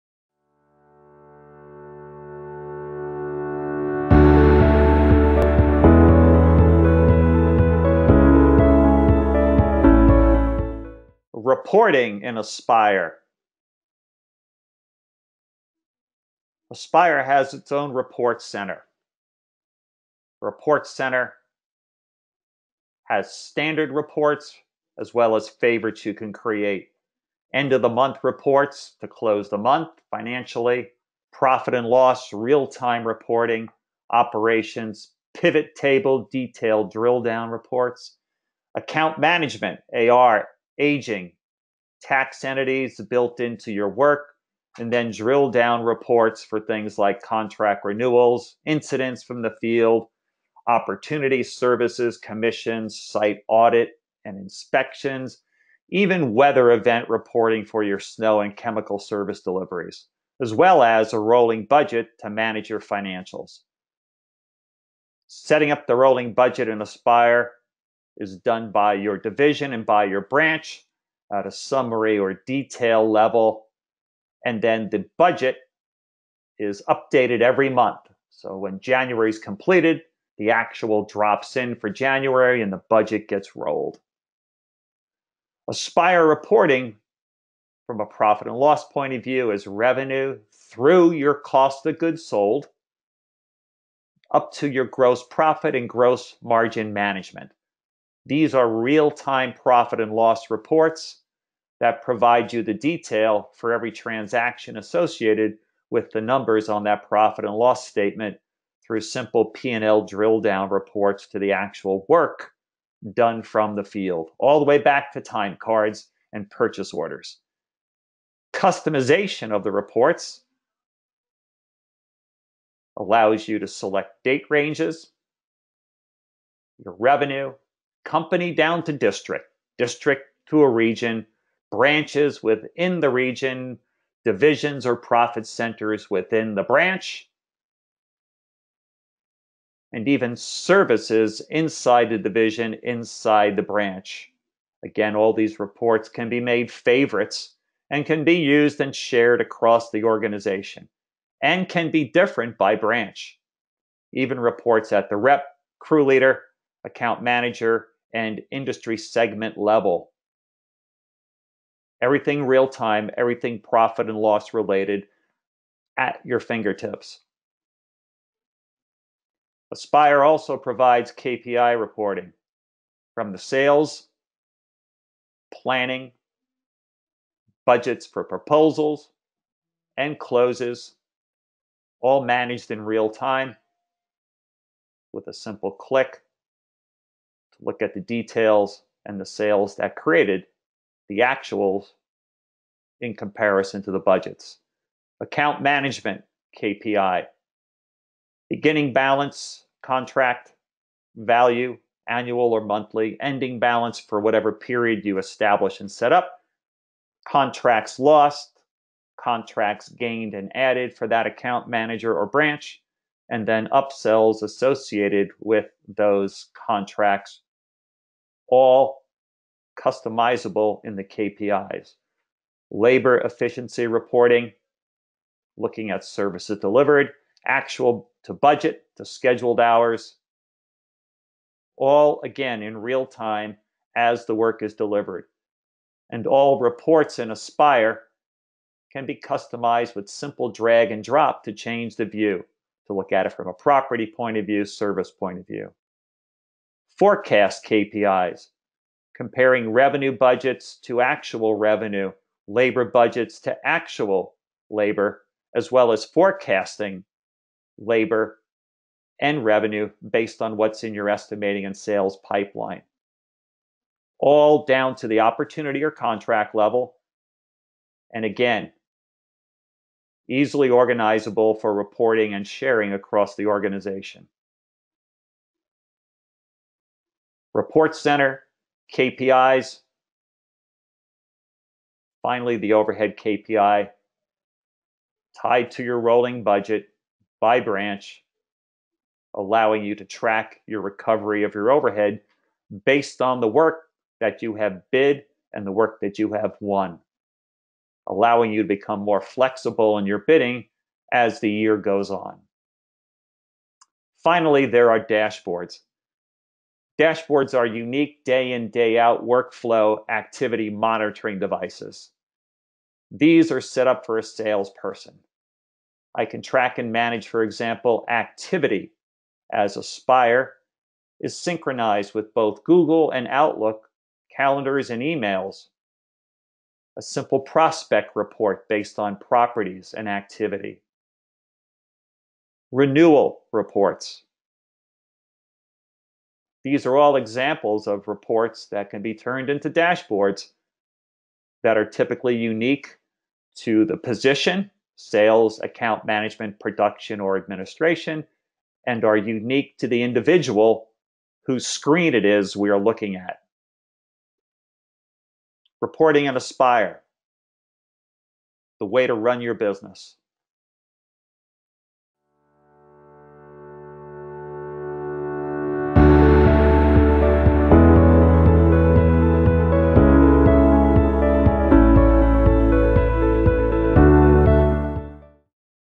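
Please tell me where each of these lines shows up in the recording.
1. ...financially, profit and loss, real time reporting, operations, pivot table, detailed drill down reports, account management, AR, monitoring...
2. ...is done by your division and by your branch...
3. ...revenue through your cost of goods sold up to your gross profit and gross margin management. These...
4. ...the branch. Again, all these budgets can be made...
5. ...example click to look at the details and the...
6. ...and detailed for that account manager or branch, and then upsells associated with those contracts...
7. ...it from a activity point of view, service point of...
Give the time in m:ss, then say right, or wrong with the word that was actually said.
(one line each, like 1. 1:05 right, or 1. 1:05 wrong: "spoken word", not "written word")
1. 0:30 wrong: "aging", not "monitoring"
2. 1:08 right
3. 1:29 right
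4. 2:23 wrong: "reports", not "budgets"
5. 3:05 wrong: "simple", not "example"
6. 3:30 wrong: "added", not "detailed"
7. 4:03 wrong: "property", not "activity".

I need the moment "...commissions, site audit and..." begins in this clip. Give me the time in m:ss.
0:52.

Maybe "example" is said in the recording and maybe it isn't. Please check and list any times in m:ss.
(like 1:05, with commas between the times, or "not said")
5:17, 5:37.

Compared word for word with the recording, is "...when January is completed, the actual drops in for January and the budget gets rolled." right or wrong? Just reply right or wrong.
right.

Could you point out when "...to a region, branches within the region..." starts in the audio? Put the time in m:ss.
2:10.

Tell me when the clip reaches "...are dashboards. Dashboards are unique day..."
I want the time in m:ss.
5:04.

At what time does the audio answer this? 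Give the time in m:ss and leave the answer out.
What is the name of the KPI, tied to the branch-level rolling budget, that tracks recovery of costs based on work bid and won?
4:42.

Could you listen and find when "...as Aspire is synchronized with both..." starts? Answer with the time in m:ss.
5:19.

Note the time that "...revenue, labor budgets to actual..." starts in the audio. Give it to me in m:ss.
4:11.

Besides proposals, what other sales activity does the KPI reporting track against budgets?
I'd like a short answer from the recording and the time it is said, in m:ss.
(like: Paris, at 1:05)
Closes, at 3:00.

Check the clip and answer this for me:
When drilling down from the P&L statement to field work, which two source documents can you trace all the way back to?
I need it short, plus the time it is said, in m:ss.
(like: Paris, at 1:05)
Time cards and purchase orders, at 1:55.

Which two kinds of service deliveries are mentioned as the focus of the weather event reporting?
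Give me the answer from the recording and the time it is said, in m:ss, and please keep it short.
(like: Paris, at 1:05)
Snow and chemical, at 0:57.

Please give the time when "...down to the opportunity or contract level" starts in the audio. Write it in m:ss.
4:24.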